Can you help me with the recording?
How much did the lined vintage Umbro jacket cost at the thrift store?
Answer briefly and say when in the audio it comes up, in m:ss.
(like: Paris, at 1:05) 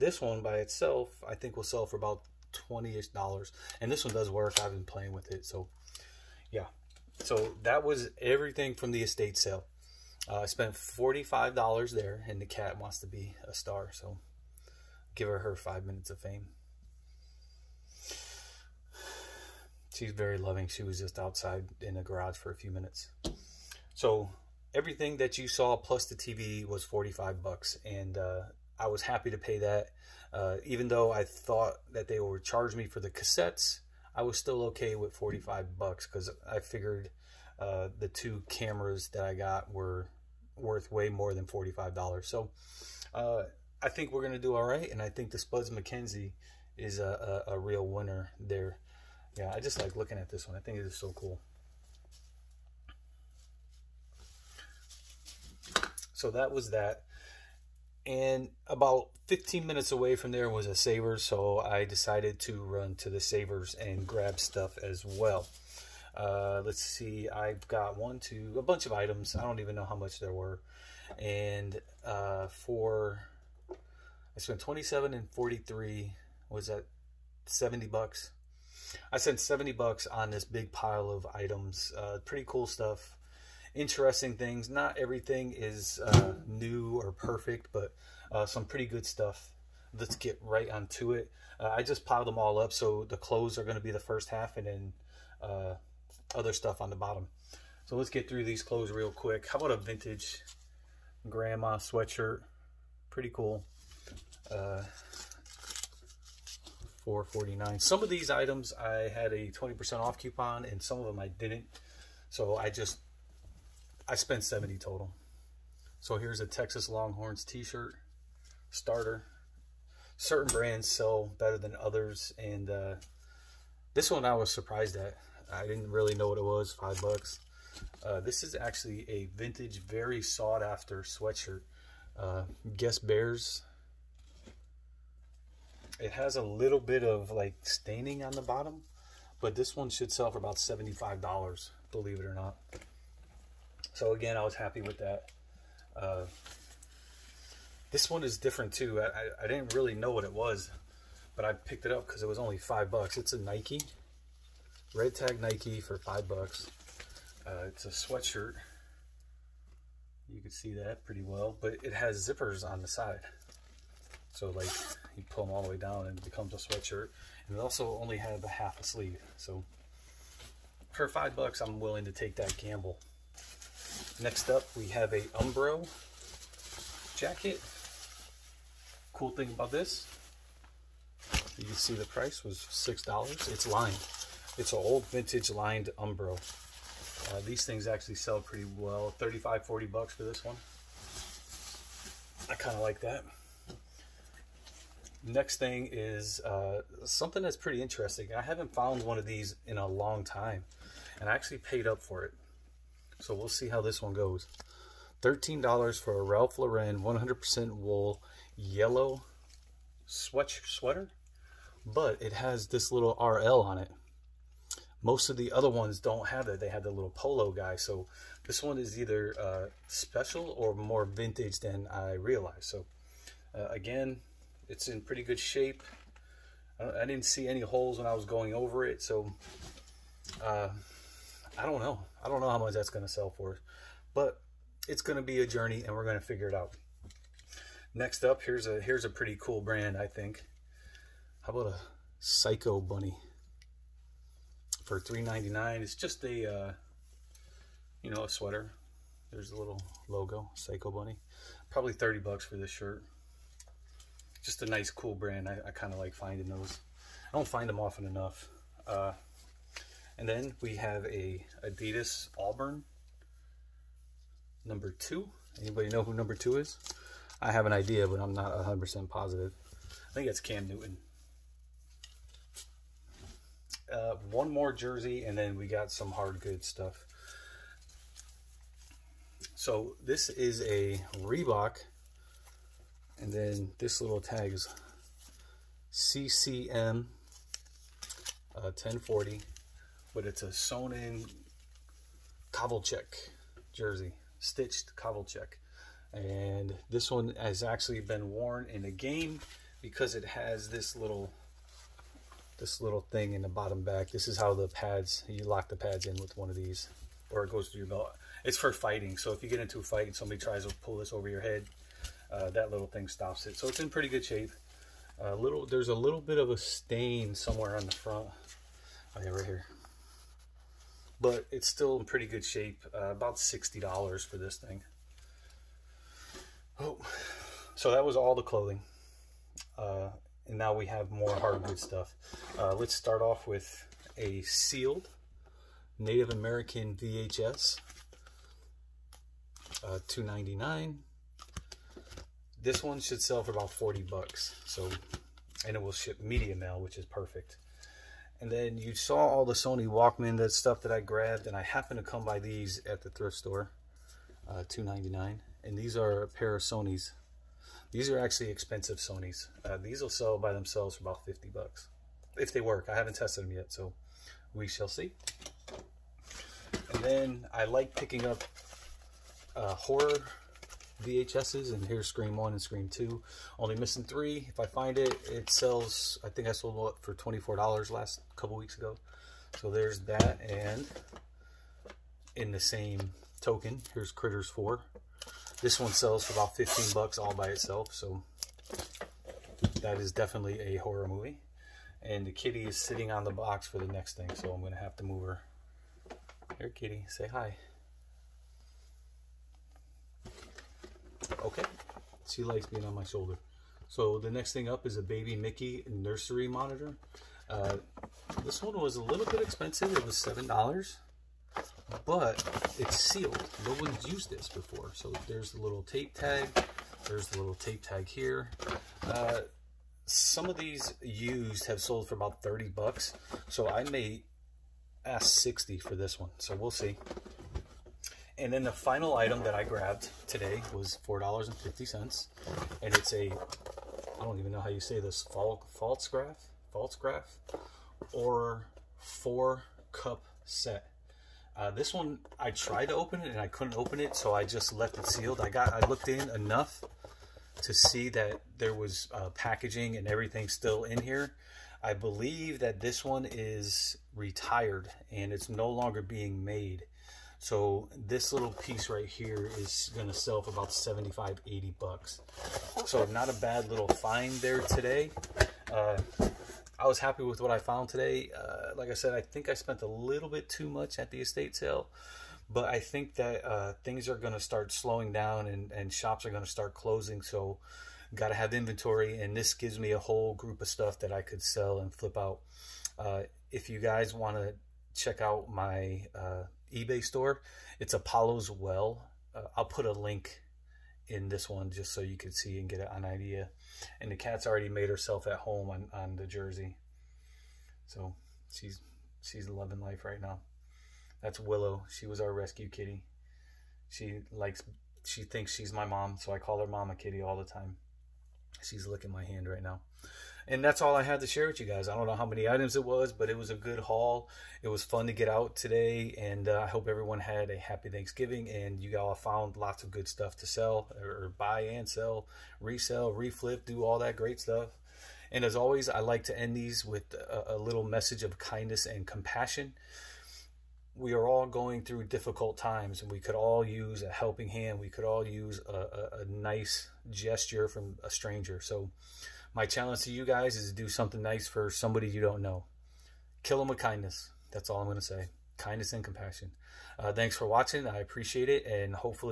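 $6, at 3:02.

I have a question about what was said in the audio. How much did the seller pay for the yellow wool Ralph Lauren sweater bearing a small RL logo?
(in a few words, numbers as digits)
$13.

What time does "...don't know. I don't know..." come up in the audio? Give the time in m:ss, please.
3:51.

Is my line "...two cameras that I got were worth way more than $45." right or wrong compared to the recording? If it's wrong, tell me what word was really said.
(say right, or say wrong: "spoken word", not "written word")
right.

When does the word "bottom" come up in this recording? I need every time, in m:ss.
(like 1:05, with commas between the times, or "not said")
1:36, 2:18, 5:03.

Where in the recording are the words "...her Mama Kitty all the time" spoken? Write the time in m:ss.
8:26.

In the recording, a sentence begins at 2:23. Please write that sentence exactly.
So again, I was happy with that.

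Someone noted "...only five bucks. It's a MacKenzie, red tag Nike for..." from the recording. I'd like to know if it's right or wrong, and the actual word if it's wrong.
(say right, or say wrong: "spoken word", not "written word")
wrong: "Nike", not "MacKenzie".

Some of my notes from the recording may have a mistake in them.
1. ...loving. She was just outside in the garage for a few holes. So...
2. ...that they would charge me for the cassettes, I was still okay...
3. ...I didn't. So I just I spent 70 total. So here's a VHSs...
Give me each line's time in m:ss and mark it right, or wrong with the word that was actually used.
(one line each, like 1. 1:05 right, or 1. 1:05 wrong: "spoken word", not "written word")
1. 0:20 wrong: "minutes", not "holes"
2. 0:31 right
3. 1:51 wrong: "Texas", not "VHSs".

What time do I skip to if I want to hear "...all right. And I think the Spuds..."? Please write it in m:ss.
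0:44.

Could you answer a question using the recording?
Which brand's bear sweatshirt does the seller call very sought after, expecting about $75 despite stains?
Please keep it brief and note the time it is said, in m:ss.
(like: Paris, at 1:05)
Guess, at 2:12.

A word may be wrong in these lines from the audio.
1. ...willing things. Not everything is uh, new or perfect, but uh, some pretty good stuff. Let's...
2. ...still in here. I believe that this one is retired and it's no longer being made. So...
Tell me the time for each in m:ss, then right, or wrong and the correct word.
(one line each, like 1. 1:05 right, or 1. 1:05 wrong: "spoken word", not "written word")
1. 1:23 wrong: "interesting", not "willing"
2. 7:30 right.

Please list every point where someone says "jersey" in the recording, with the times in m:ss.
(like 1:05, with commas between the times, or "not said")
4:34, 4:53, 8:16.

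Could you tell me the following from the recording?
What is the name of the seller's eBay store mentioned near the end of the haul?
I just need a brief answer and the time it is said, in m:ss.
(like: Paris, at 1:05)
Apollo's Well, at 8:07.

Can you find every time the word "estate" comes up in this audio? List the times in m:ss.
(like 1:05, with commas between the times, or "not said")
0:09, 7:51.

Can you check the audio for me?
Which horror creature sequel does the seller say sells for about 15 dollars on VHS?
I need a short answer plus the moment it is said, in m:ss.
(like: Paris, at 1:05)
Critters 4, at 6:24.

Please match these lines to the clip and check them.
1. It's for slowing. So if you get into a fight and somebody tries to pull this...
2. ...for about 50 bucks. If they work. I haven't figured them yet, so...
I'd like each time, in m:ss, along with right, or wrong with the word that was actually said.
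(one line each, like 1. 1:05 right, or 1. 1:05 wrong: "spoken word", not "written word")
1. 5:08 wrong: "fighting", not "slowing"
2. 6:00 wrong: "tested", not "figured".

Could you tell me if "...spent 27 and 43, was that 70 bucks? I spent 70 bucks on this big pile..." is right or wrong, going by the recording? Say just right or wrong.
right.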